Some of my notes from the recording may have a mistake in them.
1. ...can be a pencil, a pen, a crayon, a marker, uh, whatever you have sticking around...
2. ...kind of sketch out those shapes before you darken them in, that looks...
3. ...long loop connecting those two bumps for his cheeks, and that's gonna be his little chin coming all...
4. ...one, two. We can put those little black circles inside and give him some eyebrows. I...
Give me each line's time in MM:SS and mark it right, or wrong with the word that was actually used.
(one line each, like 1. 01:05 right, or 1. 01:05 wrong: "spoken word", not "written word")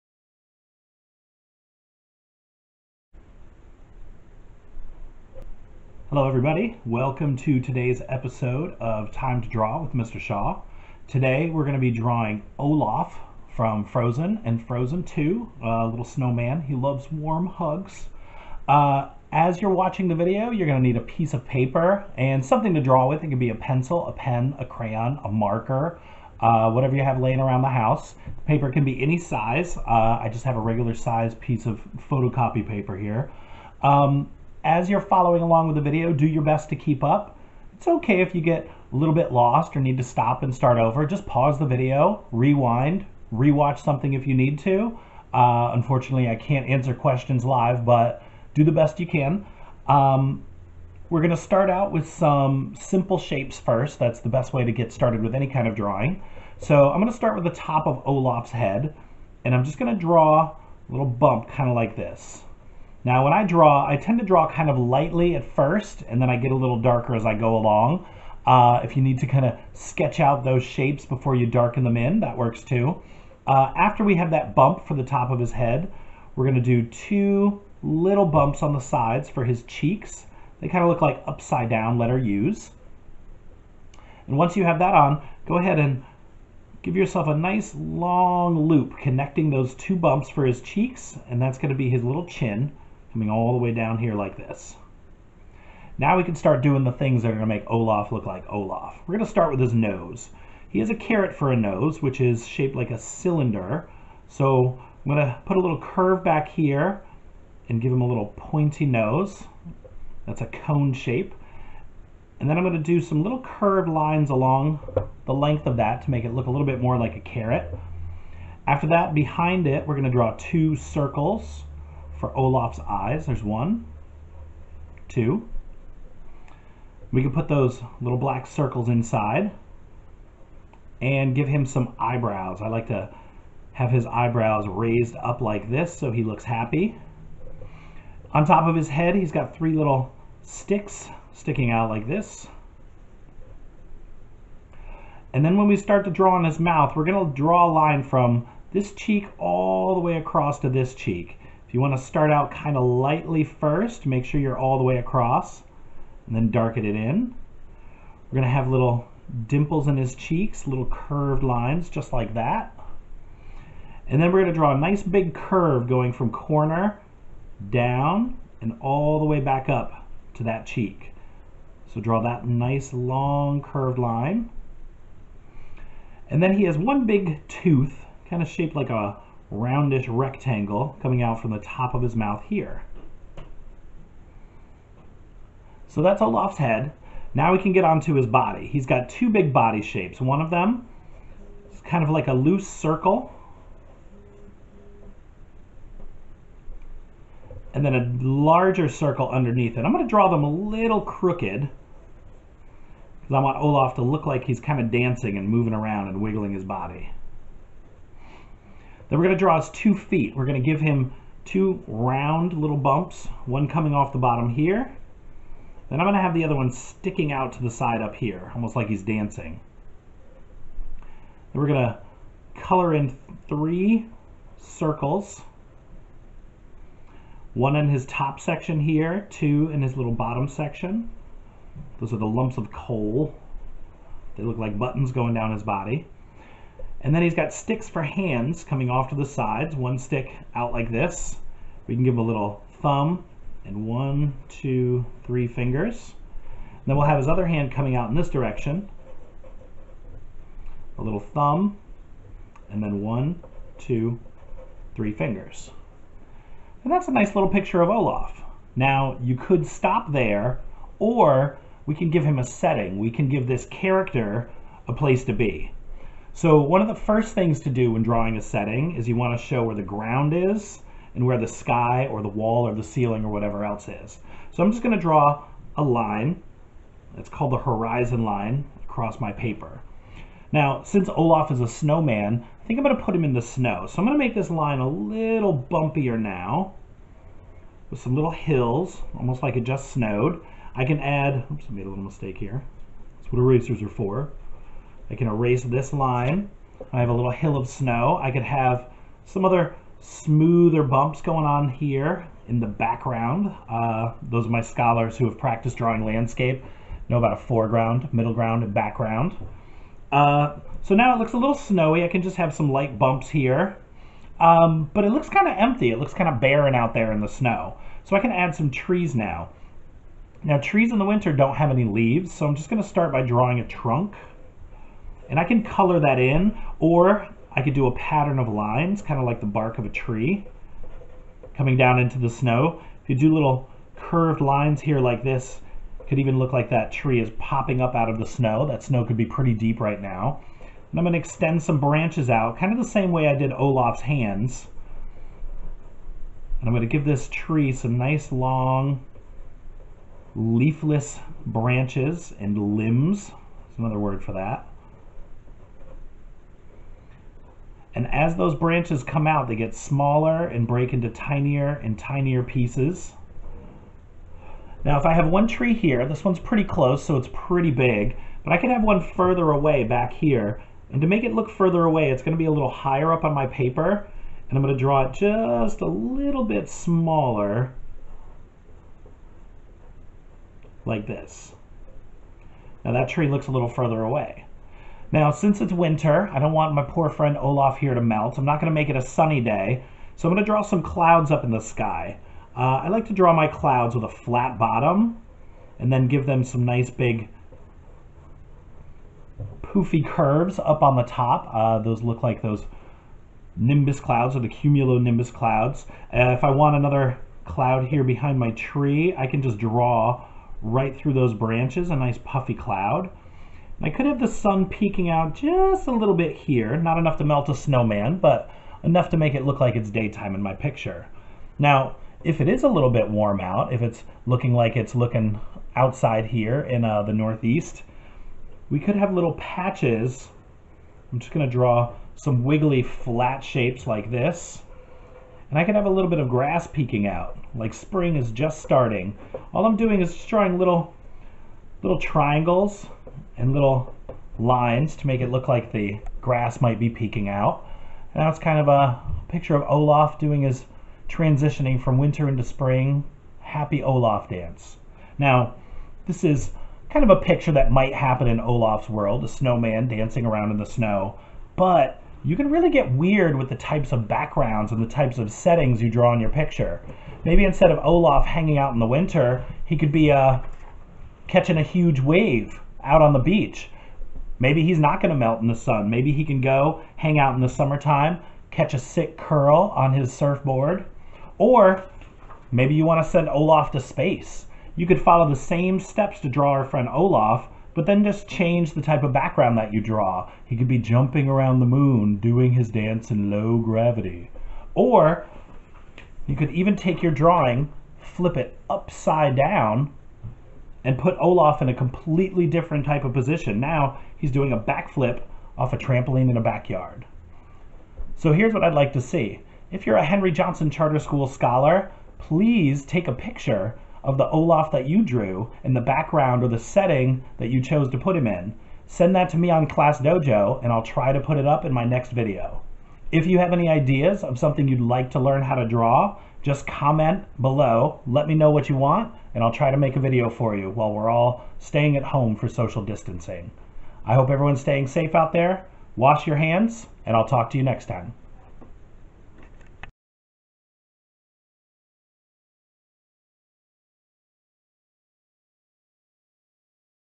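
1. 00:23 wrong: "laying", not "sticking"
2. 01:09 wrong: "works", not "looks"
3. 01:27 right
4. 02:03 right.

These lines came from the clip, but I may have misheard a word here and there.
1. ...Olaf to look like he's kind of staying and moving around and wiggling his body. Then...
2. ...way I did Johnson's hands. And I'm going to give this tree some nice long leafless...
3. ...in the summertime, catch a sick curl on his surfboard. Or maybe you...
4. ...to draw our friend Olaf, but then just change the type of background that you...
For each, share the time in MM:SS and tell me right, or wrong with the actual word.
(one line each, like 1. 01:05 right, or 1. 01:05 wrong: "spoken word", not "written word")
1. 03:23 wrong: "dancing", not "staying"
2. 05:43 wrong: "Olaf", not "Johnson"
3. 07:57 right
4. 08:06 right.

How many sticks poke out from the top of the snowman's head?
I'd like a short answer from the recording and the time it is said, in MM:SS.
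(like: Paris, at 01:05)
3, at 02:19.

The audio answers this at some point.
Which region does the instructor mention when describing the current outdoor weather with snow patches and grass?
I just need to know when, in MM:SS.
07:07.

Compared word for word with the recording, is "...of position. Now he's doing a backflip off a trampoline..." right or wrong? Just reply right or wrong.
right.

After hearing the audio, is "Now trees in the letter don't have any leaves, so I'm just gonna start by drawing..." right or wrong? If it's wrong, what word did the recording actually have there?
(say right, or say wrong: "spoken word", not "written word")
wrong: "winter", not "letter".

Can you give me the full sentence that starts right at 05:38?
That snow could be pretty deep right now.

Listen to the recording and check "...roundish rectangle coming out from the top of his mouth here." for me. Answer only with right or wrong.
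right.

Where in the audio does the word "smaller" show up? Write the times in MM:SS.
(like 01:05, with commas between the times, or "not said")
05:59, 06:16.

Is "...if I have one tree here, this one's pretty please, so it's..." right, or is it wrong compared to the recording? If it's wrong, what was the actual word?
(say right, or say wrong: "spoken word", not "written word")
wrong: "close", not "please".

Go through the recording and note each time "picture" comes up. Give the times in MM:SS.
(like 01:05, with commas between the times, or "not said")
04:17, 07:00, 07:29, 07:37, 07:46, 08:33.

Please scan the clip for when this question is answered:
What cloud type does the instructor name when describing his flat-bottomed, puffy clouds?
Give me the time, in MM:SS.
06:44.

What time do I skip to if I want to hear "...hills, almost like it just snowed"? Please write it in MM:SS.
04:48.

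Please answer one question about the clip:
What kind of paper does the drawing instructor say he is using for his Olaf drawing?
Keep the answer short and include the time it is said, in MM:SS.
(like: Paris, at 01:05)
Photocopy paper, at 00:32.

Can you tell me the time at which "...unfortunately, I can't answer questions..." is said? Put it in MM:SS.
00:45.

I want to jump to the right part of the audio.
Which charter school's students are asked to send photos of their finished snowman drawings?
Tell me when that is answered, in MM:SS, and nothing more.
08:30.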